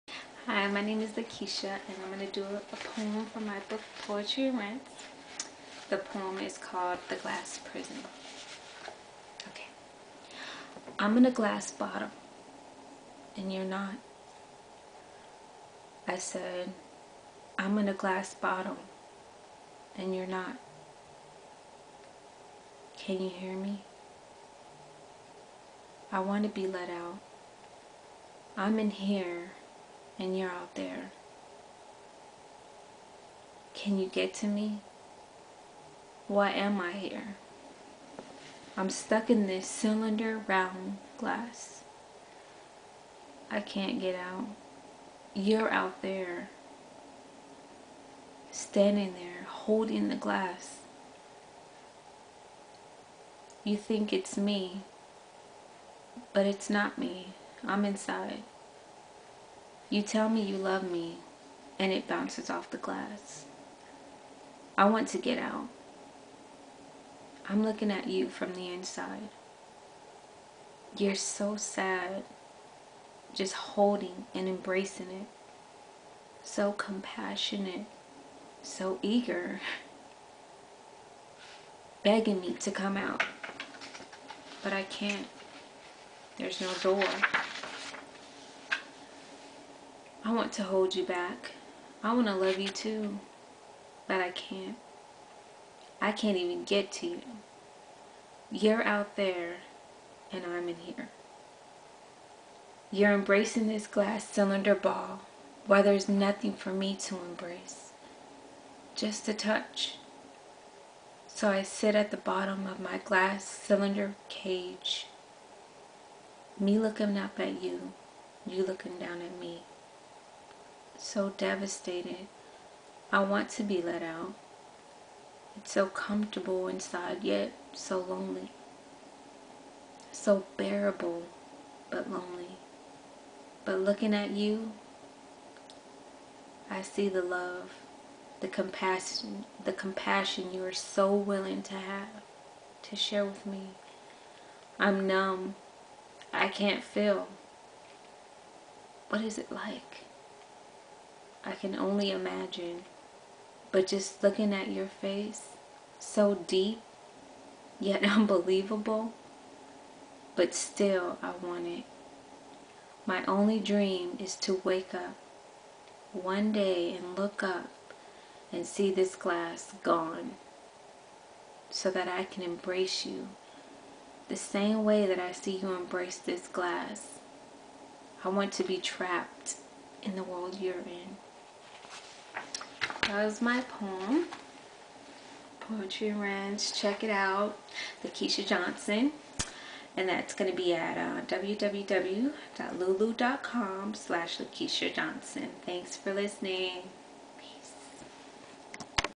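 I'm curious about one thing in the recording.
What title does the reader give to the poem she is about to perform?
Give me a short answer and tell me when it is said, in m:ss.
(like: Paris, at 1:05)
The Glass Prison, at 0:07.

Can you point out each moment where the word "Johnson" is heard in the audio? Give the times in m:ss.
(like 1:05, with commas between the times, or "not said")
3:08, 3:14.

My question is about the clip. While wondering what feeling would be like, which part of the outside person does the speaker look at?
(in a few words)
face.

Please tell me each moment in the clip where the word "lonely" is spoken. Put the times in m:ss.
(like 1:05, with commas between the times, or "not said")
2:07, 2:12.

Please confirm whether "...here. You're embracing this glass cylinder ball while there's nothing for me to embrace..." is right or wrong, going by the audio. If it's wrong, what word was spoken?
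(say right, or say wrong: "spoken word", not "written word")
right.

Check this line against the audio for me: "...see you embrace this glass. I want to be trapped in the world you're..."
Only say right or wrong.
right.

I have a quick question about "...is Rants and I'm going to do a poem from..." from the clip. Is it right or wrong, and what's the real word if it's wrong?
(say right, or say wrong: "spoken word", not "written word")
wrong: "Lakeisha", not "Rants".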